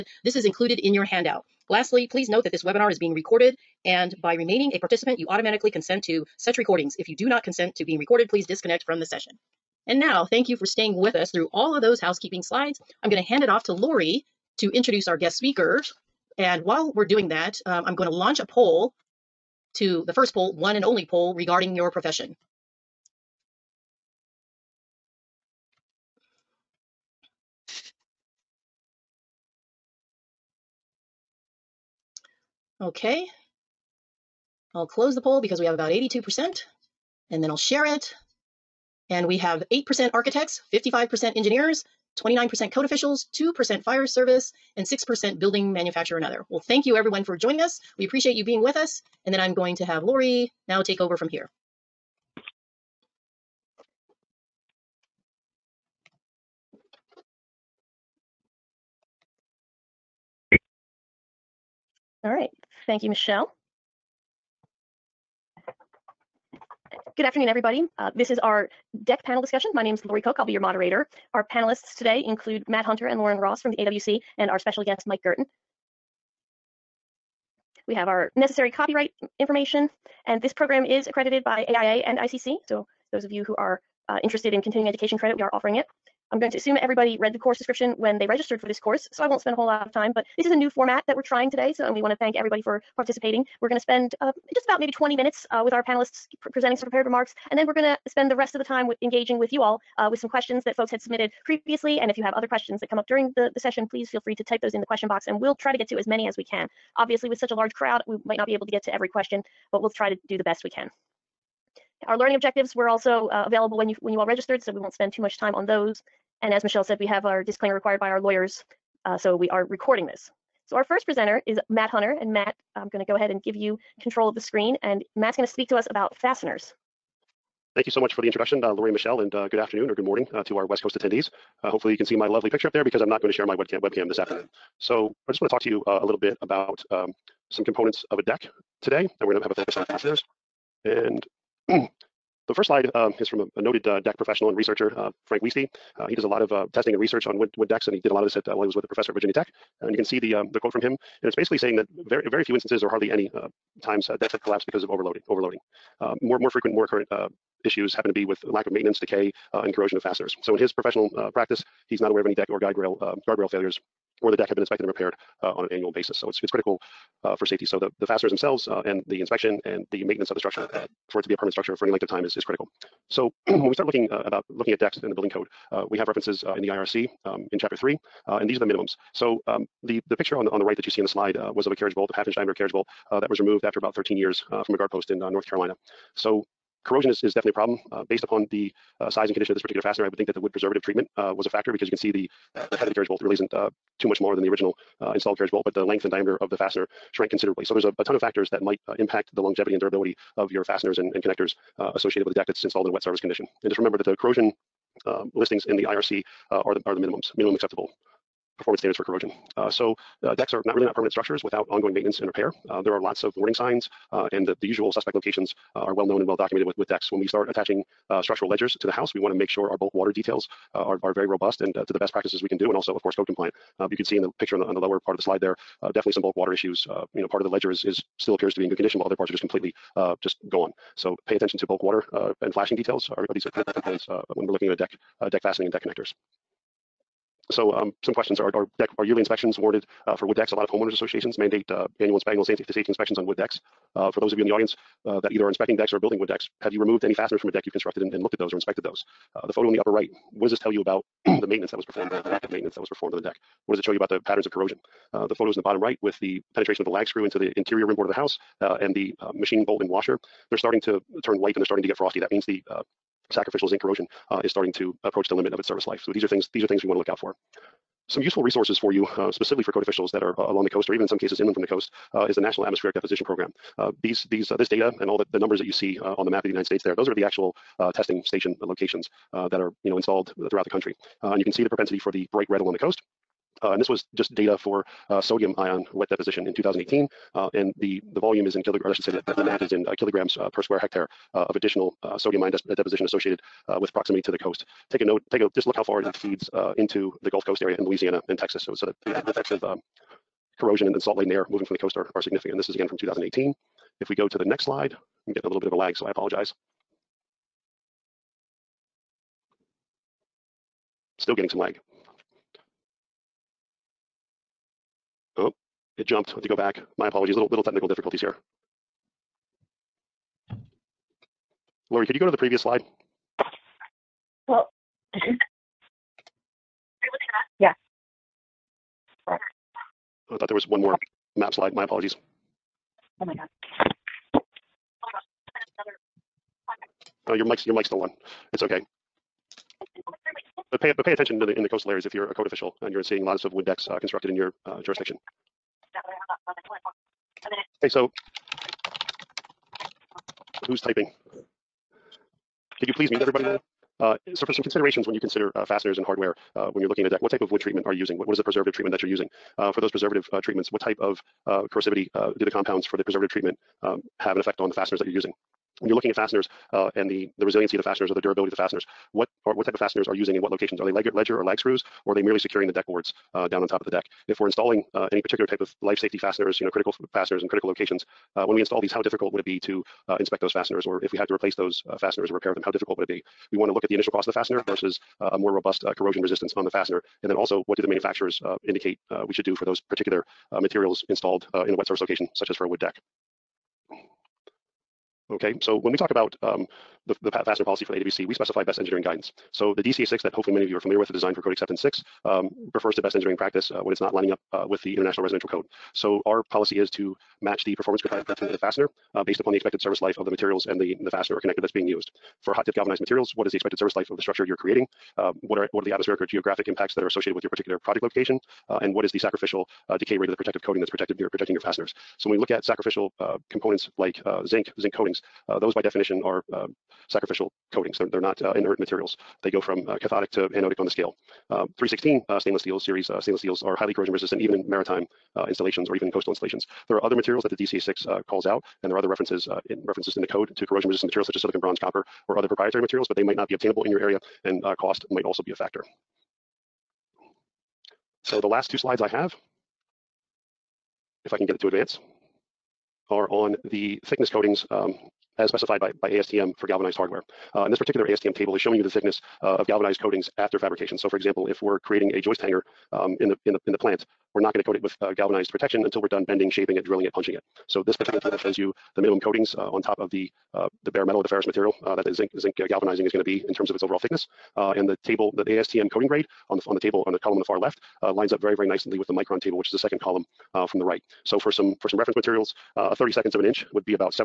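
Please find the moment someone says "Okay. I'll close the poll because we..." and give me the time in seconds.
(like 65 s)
32 s.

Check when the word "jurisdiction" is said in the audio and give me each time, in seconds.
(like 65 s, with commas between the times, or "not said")
344 s.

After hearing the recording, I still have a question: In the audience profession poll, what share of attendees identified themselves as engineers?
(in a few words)
55%.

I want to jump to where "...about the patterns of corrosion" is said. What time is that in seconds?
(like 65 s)
253 s.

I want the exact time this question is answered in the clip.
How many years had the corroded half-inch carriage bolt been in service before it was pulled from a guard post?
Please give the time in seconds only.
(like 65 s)
183 s.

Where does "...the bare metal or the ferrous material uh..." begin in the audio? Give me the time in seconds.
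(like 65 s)
470 s.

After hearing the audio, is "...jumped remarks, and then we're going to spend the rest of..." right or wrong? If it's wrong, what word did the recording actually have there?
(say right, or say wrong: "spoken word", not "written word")
wrong: "prepared", not "jumped".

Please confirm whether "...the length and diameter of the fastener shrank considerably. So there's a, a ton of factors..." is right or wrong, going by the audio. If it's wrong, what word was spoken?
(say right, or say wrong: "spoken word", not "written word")
right.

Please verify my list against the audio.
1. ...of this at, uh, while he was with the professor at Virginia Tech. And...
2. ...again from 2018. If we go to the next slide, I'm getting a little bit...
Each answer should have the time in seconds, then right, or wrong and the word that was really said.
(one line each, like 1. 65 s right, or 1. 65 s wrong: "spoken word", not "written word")
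1. 148 s right
2. 302 s right.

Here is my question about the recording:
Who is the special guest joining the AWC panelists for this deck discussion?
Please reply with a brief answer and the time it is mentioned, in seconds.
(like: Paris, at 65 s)
Mike Guertin, at 75 s.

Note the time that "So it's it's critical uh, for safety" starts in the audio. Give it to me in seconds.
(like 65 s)
166 s.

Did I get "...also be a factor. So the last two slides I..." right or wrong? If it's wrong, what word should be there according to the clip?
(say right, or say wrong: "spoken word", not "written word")
right.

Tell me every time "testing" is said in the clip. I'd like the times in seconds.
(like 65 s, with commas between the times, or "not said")
146 s, 277 s.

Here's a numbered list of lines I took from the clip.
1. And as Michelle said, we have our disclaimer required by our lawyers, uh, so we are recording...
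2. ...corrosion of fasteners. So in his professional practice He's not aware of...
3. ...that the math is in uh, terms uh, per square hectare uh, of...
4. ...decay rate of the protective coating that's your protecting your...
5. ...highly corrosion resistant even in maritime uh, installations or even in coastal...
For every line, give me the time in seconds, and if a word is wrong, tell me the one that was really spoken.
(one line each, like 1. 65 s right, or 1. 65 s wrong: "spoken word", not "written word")
1. 116 s right
2. 159 s right
3. 289 s wrong: "kilograms", not "terms"
4. 419 s right
5. 433 s right.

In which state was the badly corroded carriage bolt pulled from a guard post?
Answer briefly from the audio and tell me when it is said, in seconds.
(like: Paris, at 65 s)
North Carolina, at 185 s.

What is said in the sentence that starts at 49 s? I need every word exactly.
And then I'm going to have Lori now take over from here.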